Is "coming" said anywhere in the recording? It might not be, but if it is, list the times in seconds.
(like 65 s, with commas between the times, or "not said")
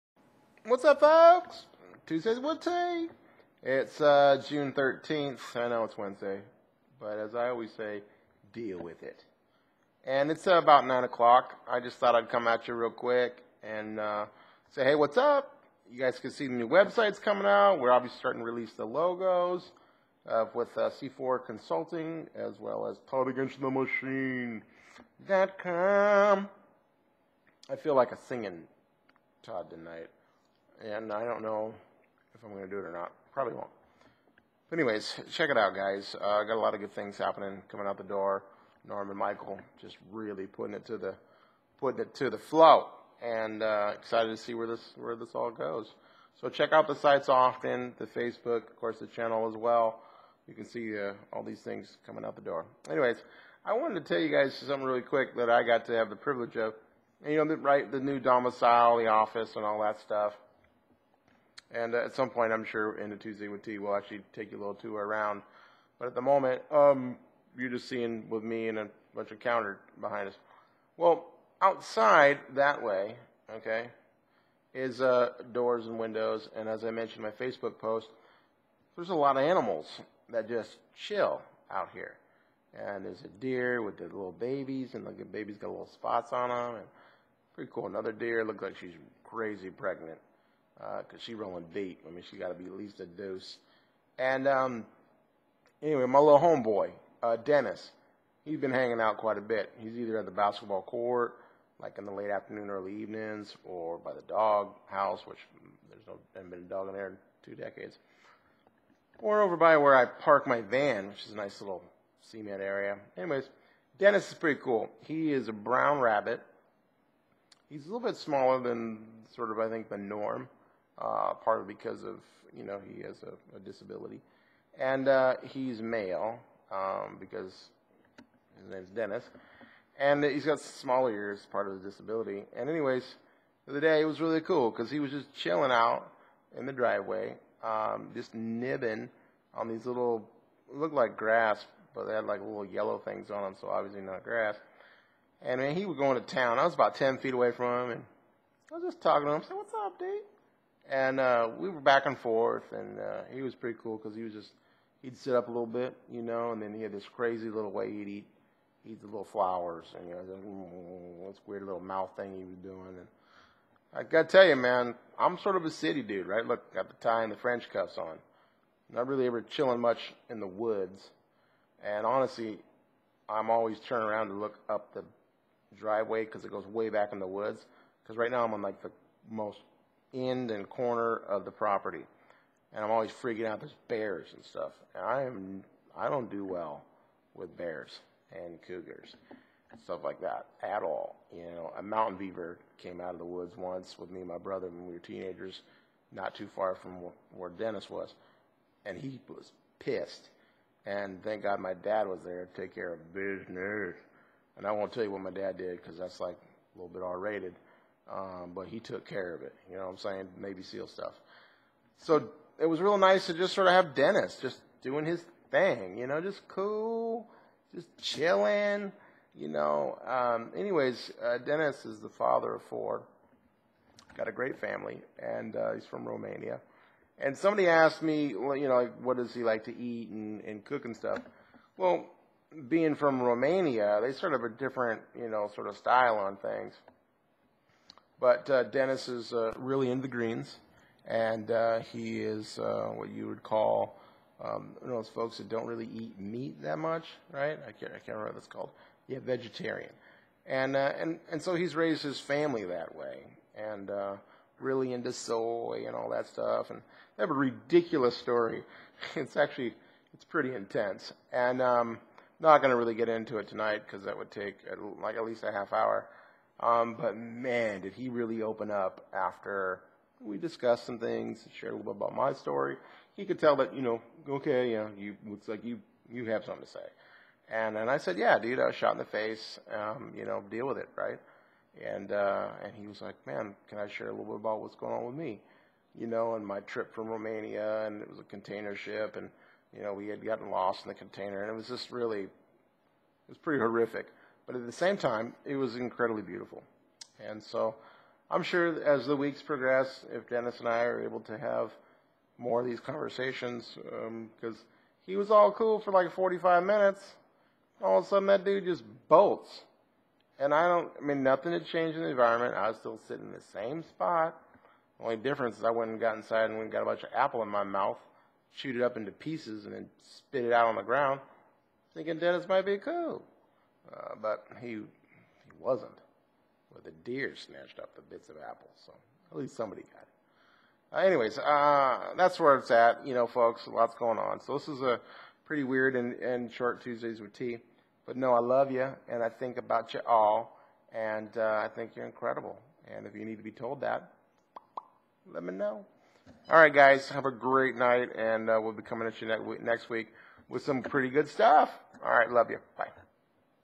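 17 s, 37 s, 52 s, 348 s.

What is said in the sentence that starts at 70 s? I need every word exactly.
Well, outside that way, okay, is uh, doors and windows.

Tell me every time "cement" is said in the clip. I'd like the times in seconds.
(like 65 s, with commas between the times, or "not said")
112 s.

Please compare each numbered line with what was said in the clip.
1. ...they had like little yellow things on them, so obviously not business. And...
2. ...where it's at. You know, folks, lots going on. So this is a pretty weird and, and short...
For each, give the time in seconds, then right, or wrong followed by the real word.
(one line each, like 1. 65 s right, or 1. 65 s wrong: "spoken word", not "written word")
1. 142 s wrong: "grass", not "business"
2. 332 s right.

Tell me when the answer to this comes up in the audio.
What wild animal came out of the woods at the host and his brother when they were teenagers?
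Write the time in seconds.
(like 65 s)
191 s.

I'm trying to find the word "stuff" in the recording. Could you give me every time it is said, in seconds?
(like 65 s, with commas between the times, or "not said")
60 s, 184 s, 189 s, 210 s, 230 s, 256 s, 351 s.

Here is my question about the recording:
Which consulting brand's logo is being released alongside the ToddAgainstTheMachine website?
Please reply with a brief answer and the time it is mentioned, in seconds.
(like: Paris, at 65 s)
C4 Consulting, at 20 s.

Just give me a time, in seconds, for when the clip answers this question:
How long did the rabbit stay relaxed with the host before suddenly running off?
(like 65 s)
306 s.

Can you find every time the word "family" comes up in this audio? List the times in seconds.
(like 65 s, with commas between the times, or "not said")
224 s, 252 s.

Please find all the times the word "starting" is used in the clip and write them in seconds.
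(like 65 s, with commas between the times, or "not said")
18 s.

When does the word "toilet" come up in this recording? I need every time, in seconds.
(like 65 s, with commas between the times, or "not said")
not said.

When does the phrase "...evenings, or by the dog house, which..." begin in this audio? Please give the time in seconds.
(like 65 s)
102 s.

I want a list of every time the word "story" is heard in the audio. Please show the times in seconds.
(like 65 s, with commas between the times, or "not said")
258 s, 272 s.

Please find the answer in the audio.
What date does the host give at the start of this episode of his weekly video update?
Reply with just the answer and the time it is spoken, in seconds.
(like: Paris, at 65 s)
June 13th, at 4 s.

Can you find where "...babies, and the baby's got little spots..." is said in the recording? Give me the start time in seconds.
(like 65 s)
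84 s.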